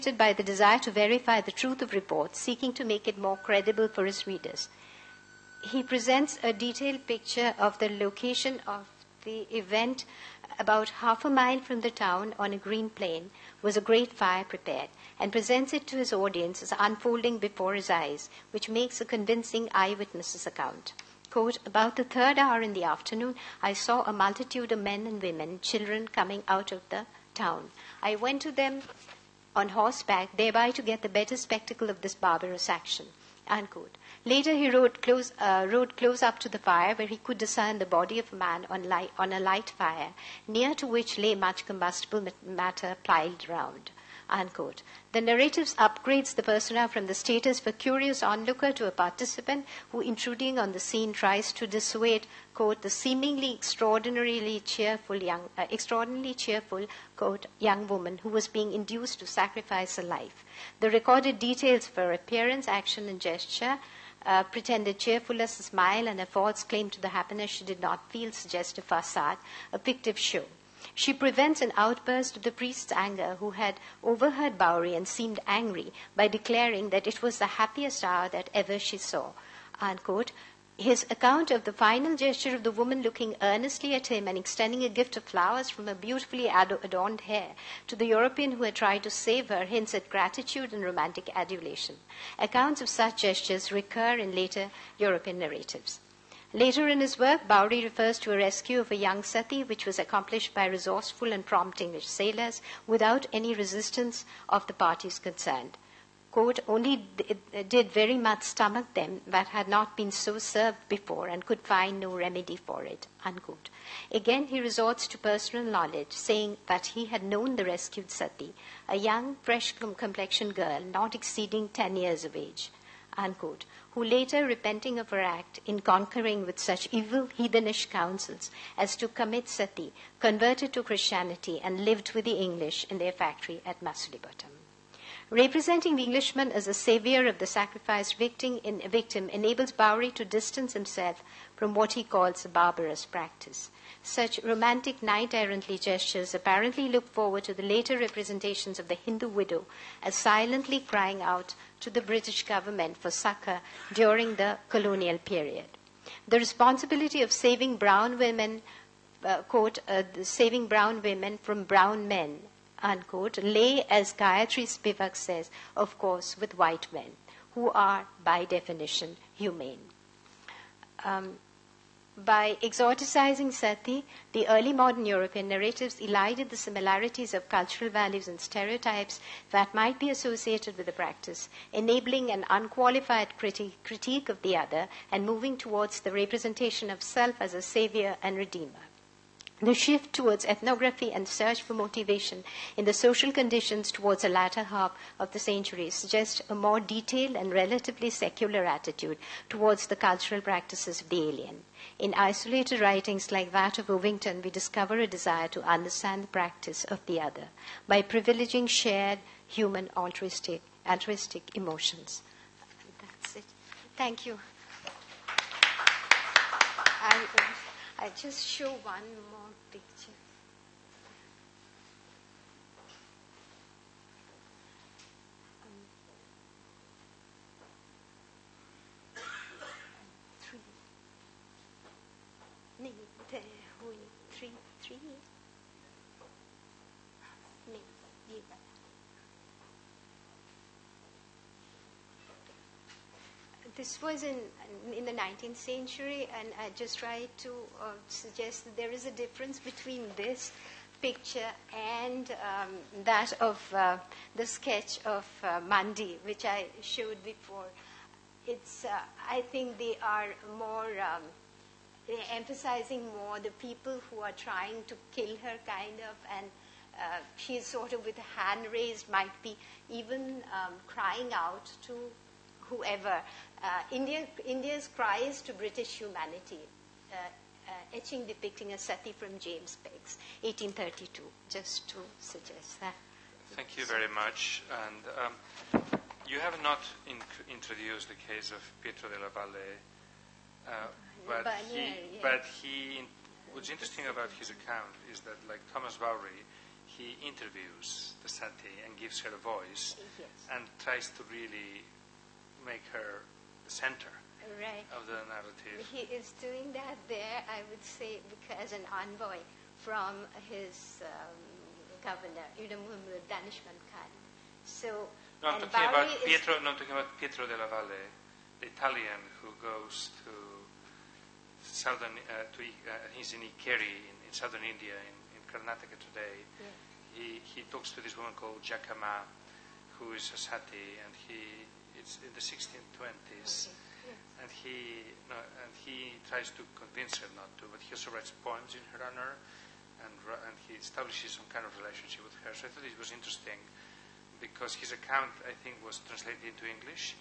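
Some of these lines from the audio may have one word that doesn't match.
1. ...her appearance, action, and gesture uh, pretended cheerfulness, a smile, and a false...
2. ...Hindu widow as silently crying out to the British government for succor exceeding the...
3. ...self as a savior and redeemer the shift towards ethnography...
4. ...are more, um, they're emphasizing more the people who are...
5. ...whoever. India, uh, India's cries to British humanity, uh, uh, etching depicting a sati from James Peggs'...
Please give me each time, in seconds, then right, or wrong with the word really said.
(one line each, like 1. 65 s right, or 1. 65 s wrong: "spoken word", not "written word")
1. 61 s right
2. 148 s wrong: "during", not "exceeding"
3. 187 s right
4. 260 s right
5. 272 s right.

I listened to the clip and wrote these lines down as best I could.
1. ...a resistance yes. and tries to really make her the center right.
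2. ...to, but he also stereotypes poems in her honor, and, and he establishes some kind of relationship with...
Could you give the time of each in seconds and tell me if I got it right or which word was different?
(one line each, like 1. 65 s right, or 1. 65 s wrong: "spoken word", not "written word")
1. 299 s wrong: "voice", not "resistance"
2. 337 s wrong: "writes", not "stereotypes".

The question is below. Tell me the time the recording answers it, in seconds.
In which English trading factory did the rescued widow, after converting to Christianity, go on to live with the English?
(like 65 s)
133 s.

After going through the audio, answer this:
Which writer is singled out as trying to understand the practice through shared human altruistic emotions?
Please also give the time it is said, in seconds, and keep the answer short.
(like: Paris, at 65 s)
Ovington, at 203 s.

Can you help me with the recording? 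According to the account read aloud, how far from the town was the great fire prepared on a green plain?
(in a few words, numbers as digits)
Half a mile.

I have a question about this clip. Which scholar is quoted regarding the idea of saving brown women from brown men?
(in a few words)
Gayatri Spivak.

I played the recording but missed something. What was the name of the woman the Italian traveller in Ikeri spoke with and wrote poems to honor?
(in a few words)
Jakama.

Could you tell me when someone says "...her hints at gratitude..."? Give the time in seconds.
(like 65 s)
89 s.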